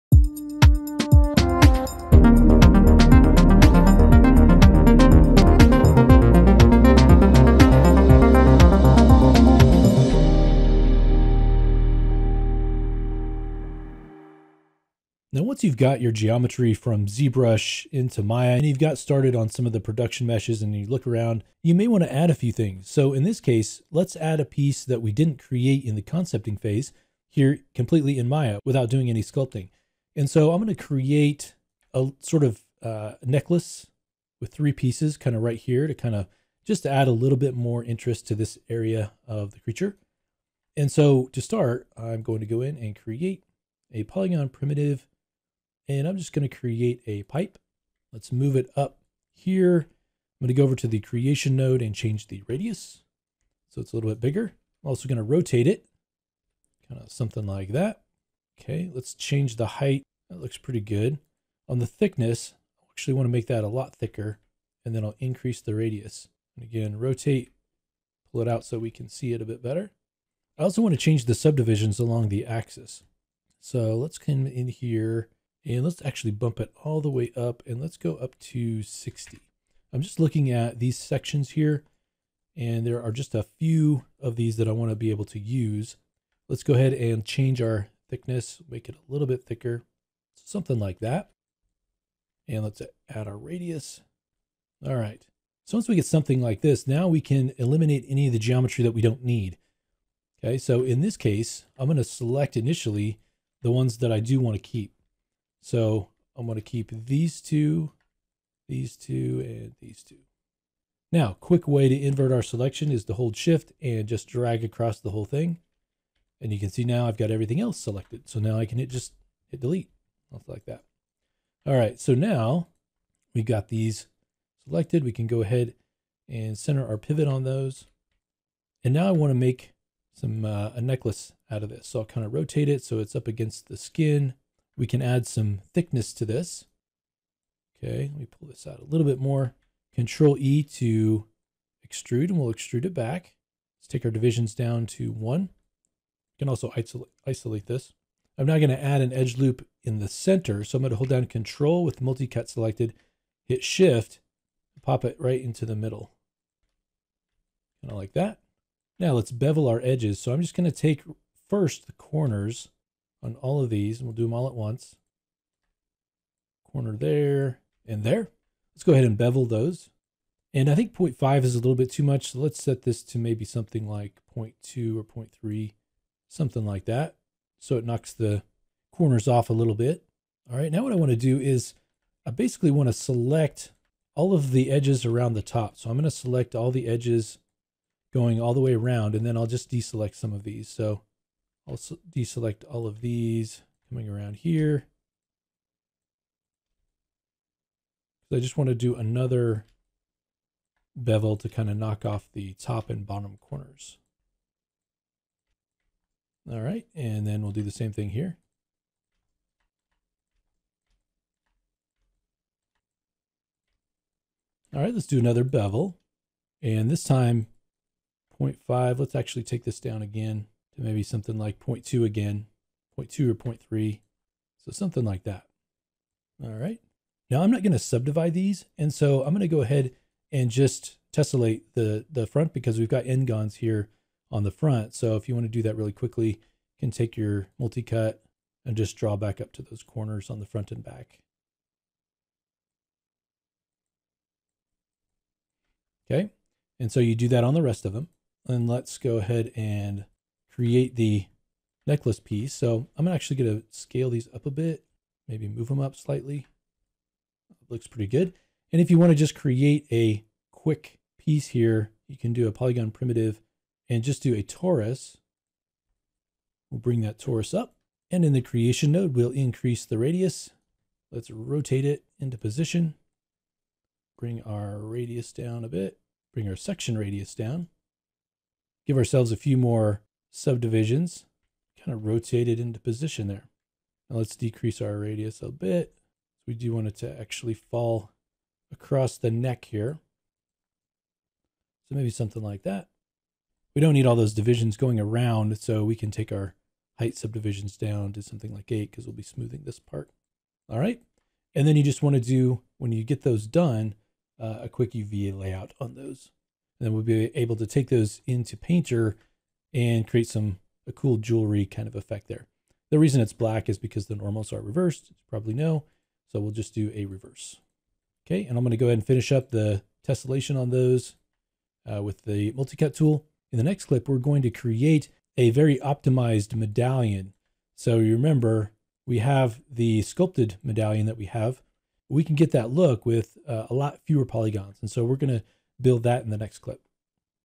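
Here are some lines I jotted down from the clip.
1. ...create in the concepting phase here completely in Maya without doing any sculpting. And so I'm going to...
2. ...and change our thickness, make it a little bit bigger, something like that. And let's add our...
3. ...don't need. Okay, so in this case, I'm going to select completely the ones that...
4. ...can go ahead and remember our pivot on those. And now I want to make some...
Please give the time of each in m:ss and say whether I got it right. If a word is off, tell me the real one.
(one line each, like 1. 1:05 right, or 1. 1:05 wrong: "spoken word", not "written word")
1. 0:25 right
2. 1:26 wrong: "thicker", not "bigger"
3. 1:39 wrong: "initially", not "completely"
4. 2:05 wrong: "center", not "remember".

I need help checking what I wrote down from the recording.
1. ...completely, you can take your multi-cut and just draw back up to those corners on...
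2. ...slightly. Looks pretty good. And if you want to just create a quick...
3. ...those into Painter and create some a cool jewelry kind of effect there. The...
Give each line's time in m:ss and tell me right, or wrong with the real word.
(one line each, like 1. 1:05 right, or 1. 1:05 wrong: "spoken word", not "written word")
1. 3:55 wrong: "quickly", not "completely"
2. 4:15 right
3. 5:07 right.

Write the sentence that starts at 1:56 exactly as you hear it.
And you can see now I've got everything else selected.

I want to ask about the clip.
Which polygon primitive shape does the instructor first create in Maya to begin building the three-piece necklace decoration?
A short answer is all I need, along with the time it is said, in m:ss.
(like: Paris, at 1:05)
Pipe, at 0:47.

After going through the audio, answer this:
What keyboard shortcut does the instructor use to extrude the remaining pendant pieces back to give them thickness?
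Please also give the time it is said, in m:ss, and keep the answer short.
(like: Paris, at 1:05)
Control E, at 2:19.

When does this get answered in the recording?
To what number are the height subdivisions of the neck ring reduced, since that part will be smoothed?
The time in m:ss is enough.
4:58.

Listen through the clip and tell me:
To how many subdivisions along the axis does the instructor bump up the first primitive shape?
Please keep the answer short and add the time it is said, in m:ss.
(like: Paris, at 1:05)
60, at 1:18.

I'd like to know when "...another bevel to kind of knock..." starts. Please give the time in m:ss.
3:18.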